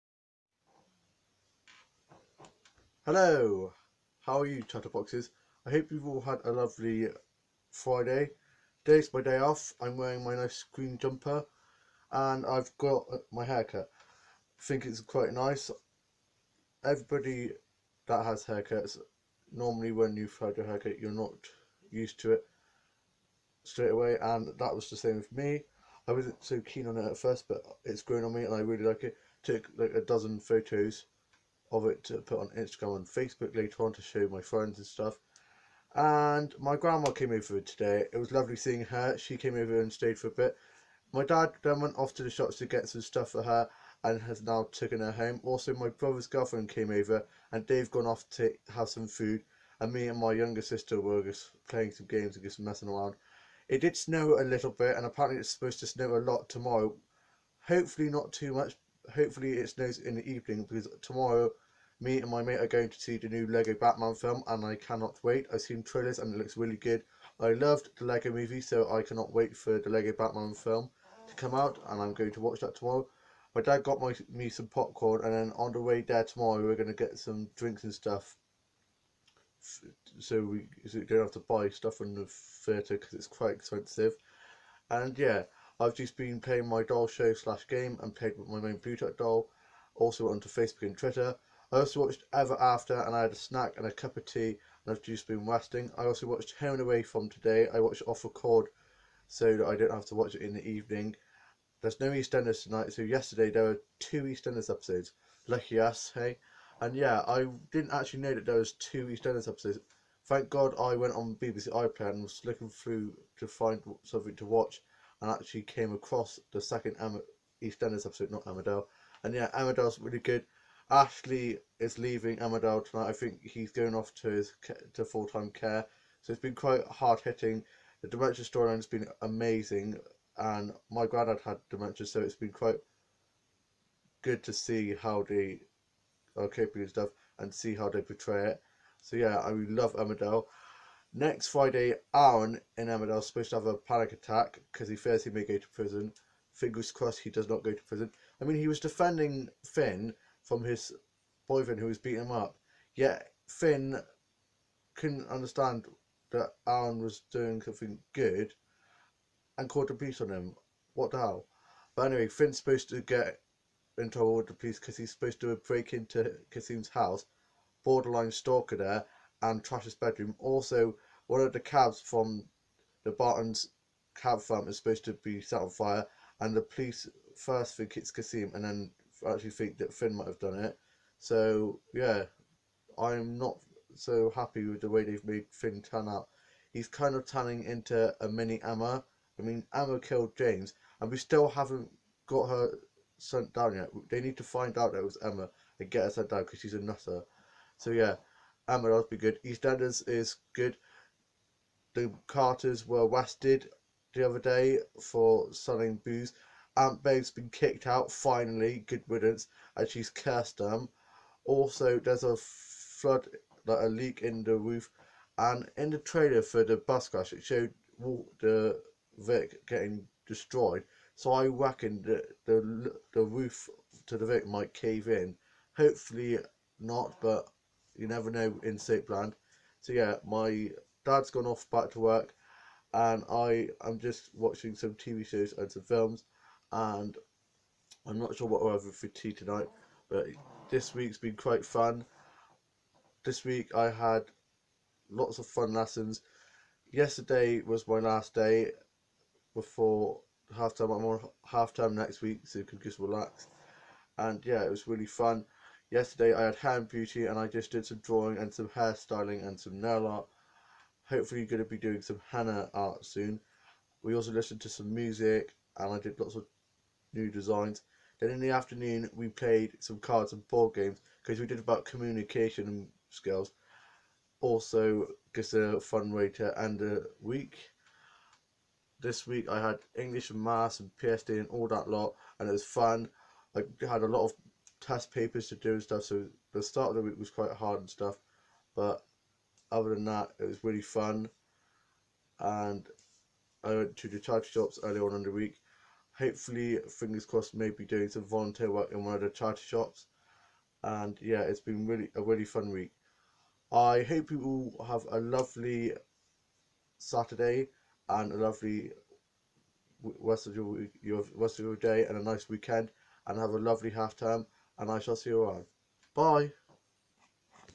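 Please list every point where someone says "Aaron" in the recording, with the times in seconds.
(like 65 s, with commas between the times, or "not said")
142 s, 156 s.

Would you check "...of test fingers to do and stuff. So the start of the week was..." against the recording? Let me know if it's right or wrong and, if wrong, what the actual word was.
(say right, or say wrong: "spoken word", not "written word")
wrong: "papers", not "fingers".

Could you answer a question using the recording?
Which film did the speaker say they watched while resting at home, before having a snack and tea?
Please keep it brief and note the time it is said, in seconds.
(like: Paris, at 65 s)
Ever After, at 92 s.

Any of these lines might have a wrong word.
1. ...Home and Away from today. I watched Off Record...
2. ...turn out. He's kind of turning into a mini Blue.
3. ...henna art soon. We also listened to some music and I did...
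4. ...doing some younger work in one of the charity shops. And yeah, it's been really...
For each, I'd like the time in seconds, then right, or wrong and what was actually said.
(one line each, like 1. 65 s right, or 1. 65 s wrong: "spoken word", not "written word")
1. 96 s right
2. 185 s wrong: "Emma", not "Blue"
3. 262 s right
4. 297 s wrong: "volunteer", not "younger".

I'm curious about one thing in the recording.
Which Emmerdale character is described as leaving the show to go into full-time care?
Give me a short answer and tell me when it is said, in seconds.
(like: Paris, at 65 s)
Ashley, at 120 s.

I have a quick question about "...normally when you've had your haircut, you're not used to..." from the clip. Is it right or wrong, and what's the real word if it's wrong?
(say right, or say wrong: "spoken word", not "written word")
right.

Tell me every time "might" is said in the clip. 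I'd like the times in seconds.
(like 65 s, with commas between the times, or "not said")
180 s, 224 s.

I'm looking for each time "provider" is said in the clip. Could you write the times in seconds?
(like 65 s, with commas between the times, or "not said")
not said.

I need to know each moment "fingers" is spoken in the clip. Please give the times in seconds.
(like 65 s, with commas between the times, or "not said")
146 s, 296 s.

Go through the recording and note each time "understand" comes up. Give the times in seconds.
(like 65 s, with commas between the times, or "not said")
155 s.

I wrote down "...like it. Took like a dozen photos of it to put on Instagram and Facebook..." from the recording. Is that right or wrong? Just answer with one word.
right.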